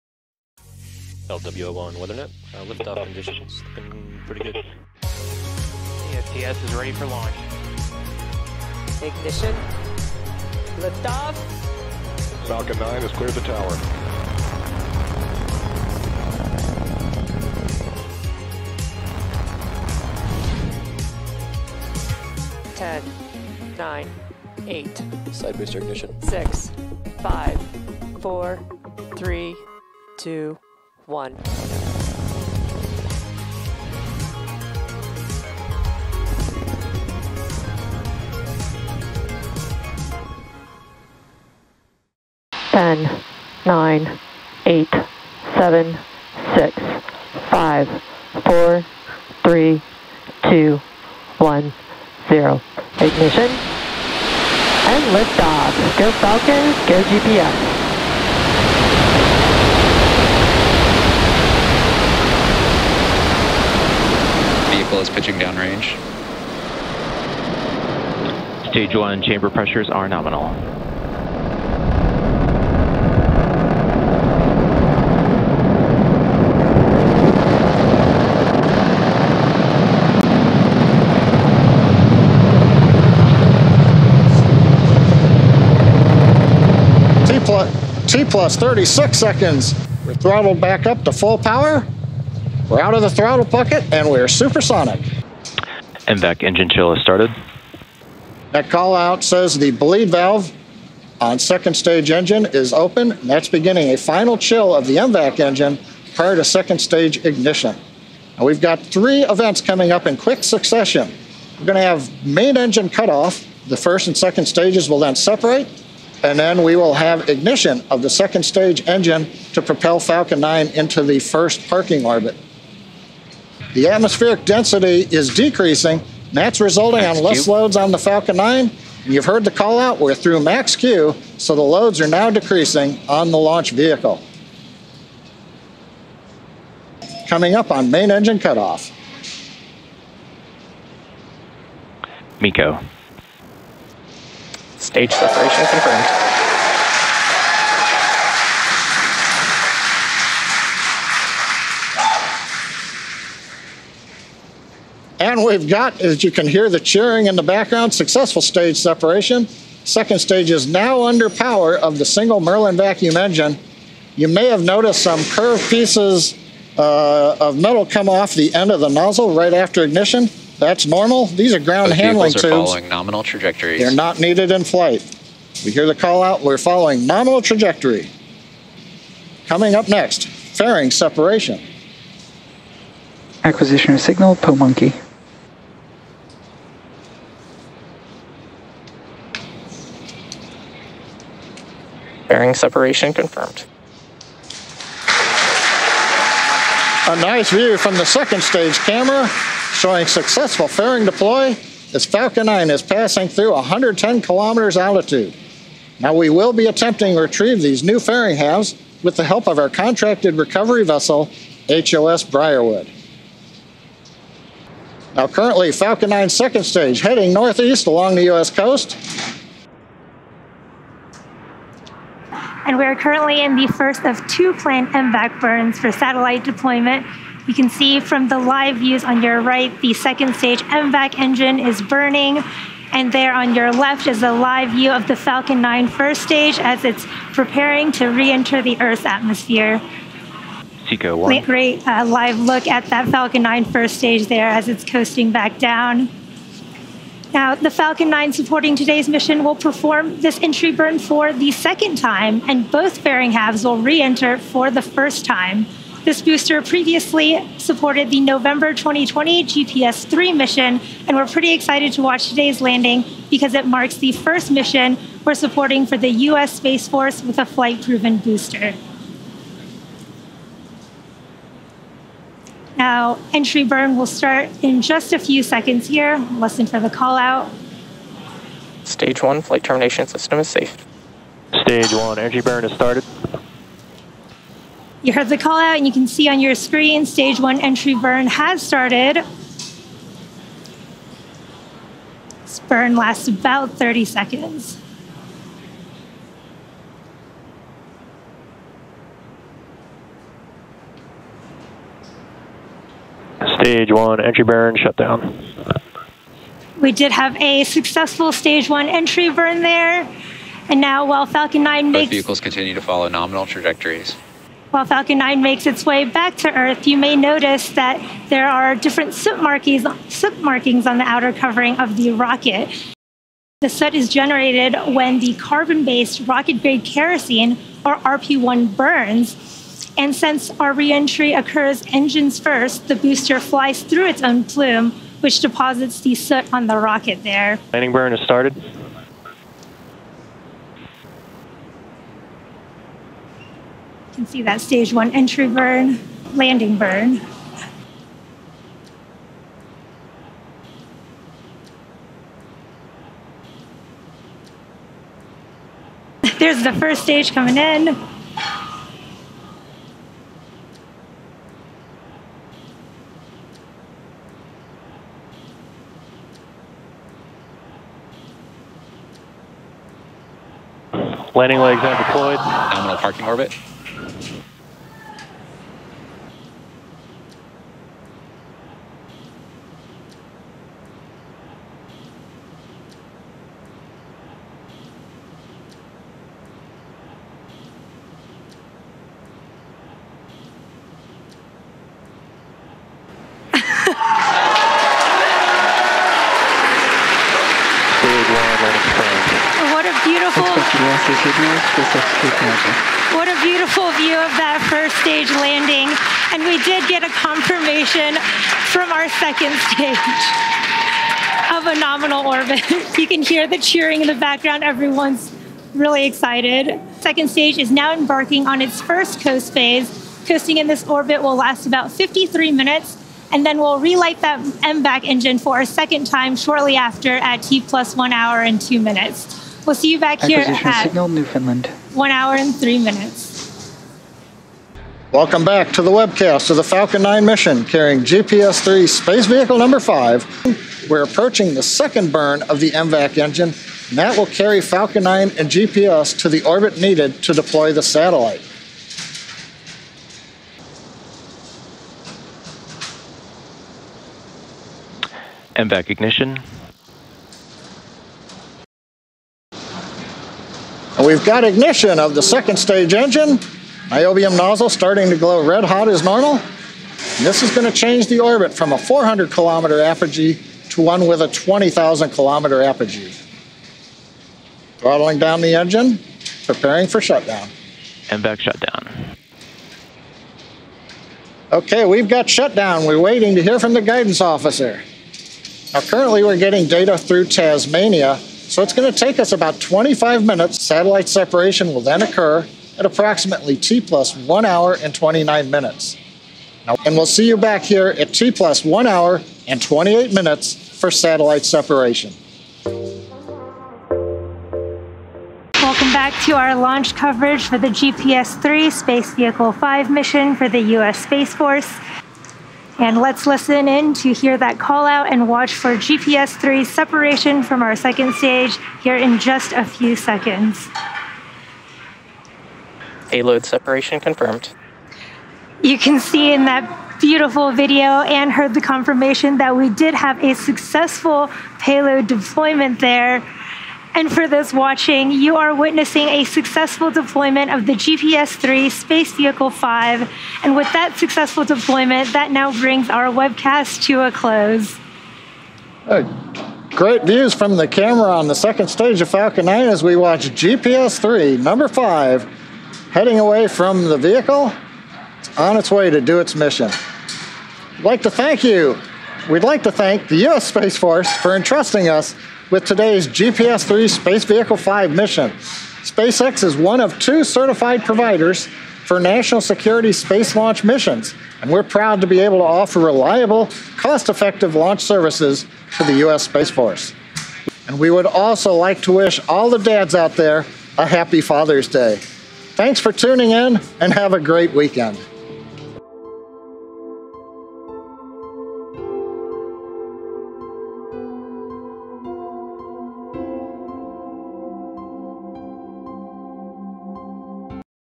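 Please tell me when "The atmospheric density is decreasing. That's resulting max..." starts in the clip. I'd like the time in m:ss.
2:03.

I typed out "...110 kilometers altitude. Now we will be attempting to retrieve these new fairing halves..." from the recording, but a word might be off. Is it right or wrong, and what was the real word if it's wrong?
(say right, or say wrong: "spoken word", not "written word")
right.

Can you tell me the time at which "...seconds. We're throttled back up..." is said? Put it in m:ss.
1:29.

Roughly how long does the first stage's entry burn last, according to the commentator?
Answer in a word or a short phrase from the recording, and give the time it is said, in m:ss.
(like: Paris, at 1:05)
30 seconds, at 4:53.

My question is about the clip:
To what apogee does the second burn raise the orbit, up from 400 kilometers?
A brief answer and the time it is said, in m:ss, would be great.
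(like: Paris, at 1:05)
20,000 kilometers, at 7:51.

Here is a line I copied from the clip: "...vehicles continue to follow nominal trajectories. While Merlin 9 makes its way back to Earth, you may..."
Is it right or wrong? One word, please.
wrong.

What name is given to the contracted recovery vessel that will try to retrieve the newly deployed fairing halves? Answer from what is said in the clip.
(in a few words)
HOS Briarwood.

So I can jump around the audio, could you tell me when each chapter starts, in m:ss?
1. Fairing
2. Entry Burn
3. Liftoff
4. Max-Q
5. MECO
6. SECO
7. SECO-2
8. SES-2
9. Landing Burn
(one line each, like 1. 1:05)
1. 3:13
2. 4:41
3. 0:55
4. 2:07
5. 2:22
6. 4:01
7. 7:57
8. 7:33
9. 5:36.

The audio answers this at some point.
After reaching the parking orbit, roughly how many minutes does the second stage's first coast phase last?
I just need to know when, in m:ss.
7:01.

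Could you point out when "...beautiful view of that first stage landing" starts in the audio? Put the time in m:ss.
6:43.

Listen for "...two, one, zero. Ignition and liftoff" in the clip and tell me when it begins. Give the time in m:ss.
0:50.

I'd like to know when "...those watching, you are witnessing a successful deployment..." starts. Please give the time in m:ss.
8:54.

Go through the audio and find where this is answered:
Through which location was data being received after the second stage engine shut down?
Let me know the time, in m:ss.
8:07.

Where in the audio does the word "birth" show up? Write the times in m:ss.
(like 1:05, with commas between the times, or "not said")
not said.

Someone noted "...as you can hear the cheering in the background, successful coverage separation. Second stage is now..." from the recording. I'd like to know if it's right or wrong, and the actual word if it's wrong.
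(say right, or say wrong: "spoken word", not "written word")
wrong: "stage", not "coverage".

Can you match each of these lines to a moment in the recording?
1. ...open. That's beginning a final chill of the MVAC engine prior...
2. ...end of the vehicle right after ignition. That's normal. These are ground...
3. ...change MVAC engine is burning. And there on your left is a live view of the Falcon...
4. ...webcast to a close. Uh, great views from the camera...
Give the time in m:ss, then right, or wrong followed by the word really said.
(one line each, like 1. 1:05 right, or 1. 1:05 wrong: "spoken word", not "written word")
1. 1:42 right
2. 2:48 wrong: "nozzle", not "vehicle"
3. 3:50 wrong: "stage", not "change"
4. 9:03 right.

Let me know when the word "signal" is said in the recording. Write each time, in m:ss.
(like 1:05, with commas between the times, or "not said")
3:04, 7:10.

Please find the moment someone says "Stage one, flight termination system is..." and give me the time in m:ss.
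4:38.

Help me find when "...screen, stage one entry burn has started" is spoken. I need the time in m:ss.
4:46.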